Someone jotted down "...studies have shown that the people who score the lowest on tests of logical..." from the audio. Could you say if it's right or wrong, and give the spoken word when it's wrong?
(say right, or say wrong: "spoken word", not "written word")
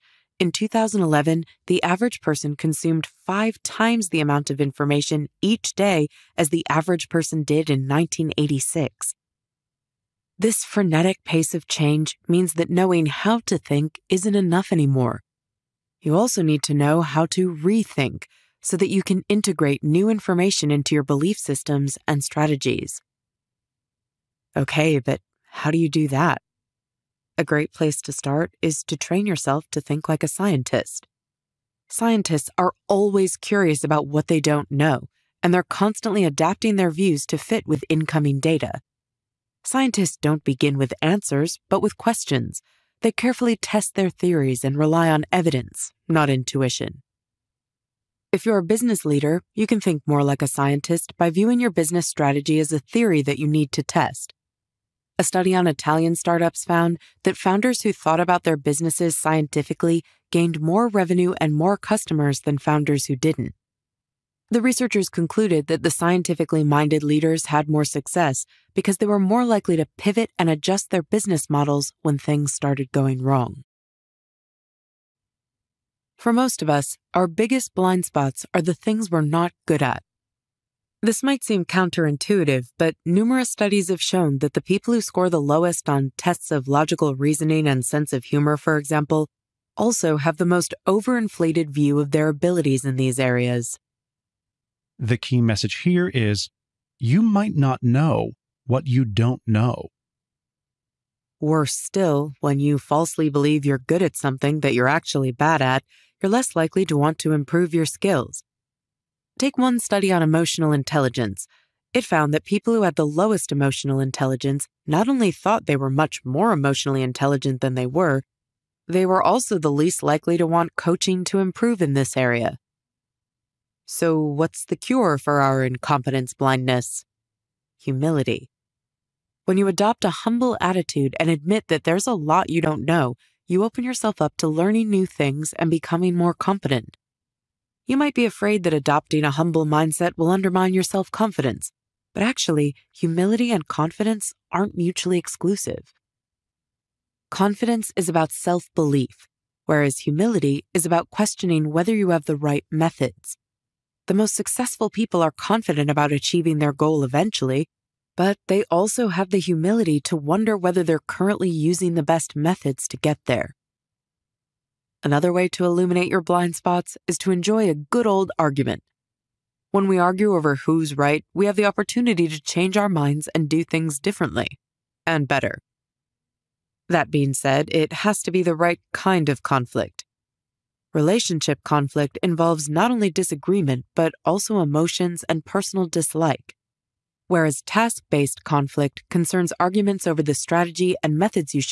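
right.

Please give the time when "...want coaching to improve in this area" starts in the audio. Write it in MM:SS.
02:00.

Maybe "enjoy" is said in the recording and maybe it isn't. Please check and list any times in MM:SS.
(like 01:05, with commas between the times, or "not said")
02:47.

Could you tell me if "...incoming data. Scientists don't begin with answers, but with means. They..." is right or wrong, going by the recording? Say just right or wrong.
wrong.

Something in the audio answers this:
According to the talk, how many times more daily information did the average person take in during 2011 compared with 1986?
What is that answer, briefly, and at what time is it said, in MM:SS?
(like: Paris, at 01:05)
5, at 00:03.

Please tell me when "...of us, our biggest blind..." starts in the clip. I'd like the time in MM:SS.
01:16.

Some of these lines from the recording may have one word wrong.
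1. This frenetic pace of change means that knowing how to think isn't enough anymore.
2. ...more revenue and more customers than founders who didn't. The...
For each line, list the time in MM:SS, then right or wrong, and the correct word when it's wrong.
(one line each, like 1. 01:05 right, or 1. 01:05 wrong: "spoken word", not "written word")
1. 00:10 right
2. 01:00 right.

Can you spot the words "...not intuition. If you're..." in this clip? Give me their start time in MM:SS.
00:46.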